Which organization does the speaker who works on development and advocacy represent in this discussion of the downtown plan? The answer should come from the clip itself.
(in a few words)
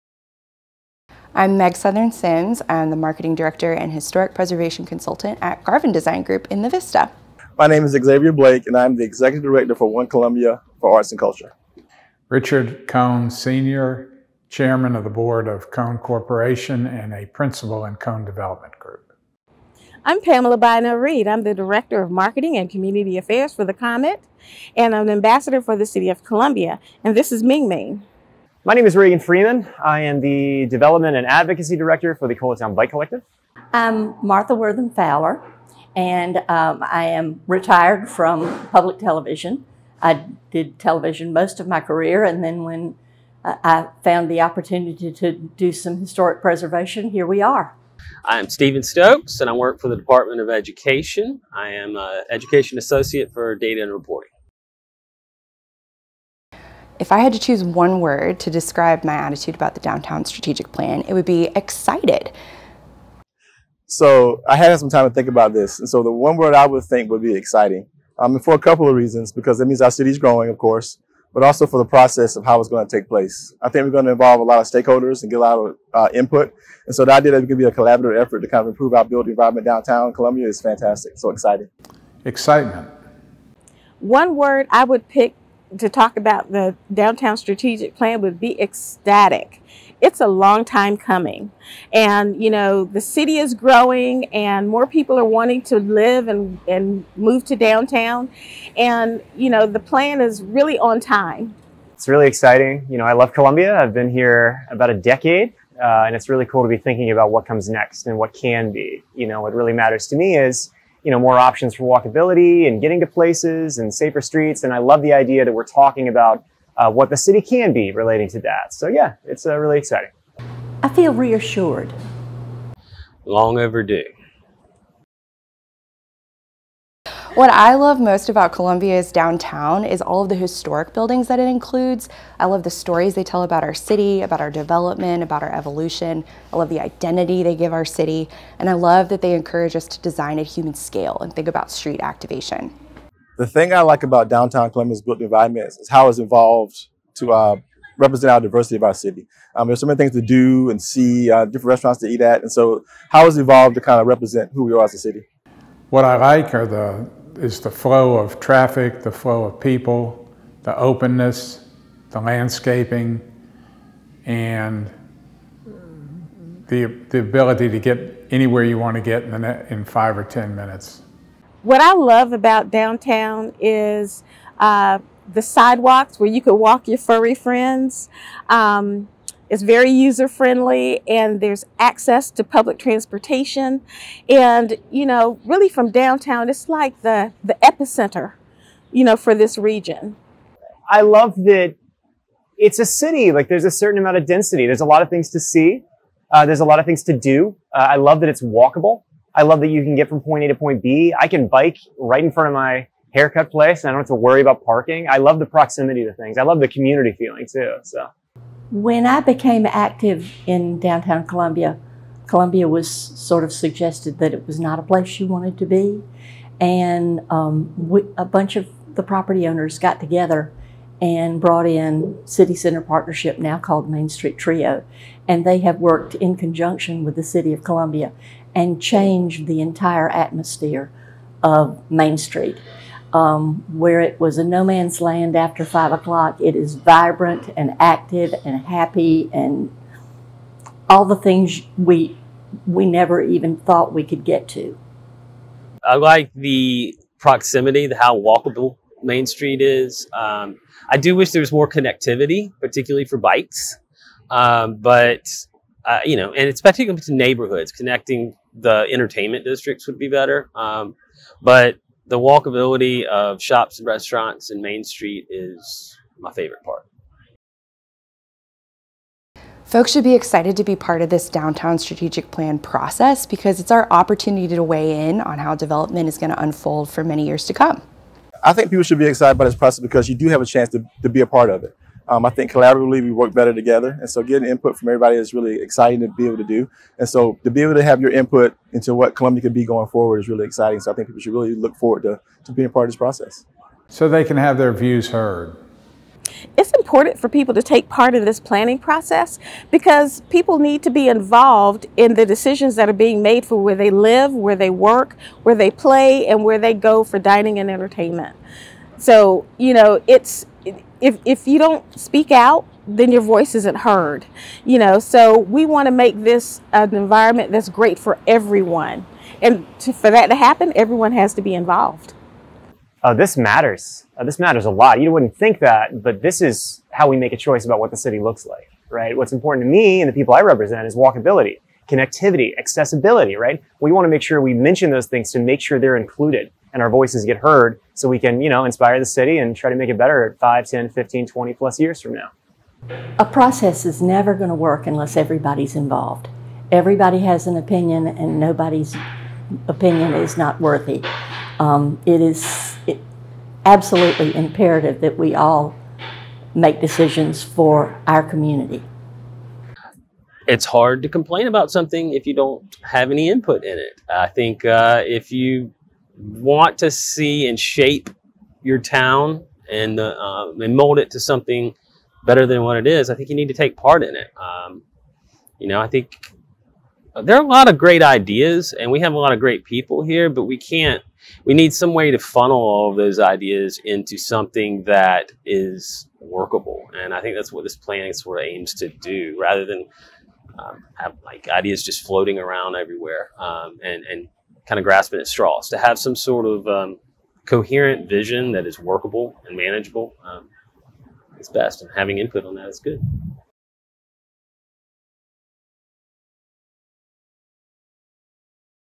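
Colatown Bike Collective.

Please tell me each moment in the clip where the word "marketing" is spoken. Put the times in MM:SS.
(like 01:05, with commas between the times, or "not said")
00:02, 00:22.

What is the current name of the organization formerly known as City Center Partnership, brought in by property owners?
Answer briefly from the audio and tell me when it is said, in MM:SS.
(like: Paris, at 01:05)
Main Street Trio, at 03:43.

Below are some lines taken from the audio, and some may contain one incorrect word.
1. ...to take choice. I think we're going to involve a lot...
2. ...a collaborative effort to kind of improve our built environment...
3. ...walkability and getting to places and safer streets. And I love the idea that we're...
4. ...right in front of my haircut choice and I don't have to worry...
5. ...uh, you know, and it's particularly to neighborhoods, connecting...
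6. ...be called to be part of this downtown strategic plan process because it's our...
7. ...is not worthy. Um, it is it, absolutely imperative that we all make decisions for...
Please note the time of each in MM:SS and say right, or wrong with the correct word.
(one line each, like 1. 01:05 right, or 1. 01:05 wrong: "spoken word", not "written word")
1. 01:12 wrong: "place", not "choice"
2. 01:17 right
3. 01:51 right
4. 03:21 wrong: "place", not "choice"
5. 04:15 right
6. 04:30 wrong: "excited", not "called"
7. 05:50 right.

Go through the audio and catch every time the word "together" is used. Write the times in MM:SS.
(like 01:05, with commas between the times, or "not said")
03:39, 04:43.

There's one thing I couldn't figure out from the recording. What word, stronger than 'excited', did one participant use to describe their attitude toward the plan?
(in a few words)
ecstatic.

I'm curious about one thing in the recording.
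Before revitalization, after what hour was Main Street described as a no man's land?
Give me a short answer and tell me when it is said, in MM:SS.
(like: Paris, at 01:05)
5 o'clock, at 03:55.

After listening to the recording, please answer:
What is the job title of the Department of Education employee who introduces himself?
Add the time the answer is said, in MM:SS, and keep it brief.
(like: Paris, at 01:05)
Education Associate for Data and Reporting, at 00:52.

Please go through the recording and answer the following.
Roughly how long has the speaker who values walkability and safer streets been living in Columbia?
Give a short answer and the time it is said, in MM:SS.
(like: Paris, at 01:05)
about a decade, at 01:44.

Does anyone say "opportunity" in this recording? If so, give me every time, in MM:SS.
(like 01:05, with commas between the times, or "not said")
00:44, 04:33.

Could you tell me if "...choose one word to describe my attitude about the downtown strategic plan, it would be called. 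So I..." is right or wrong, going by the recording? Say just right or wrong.
wrong.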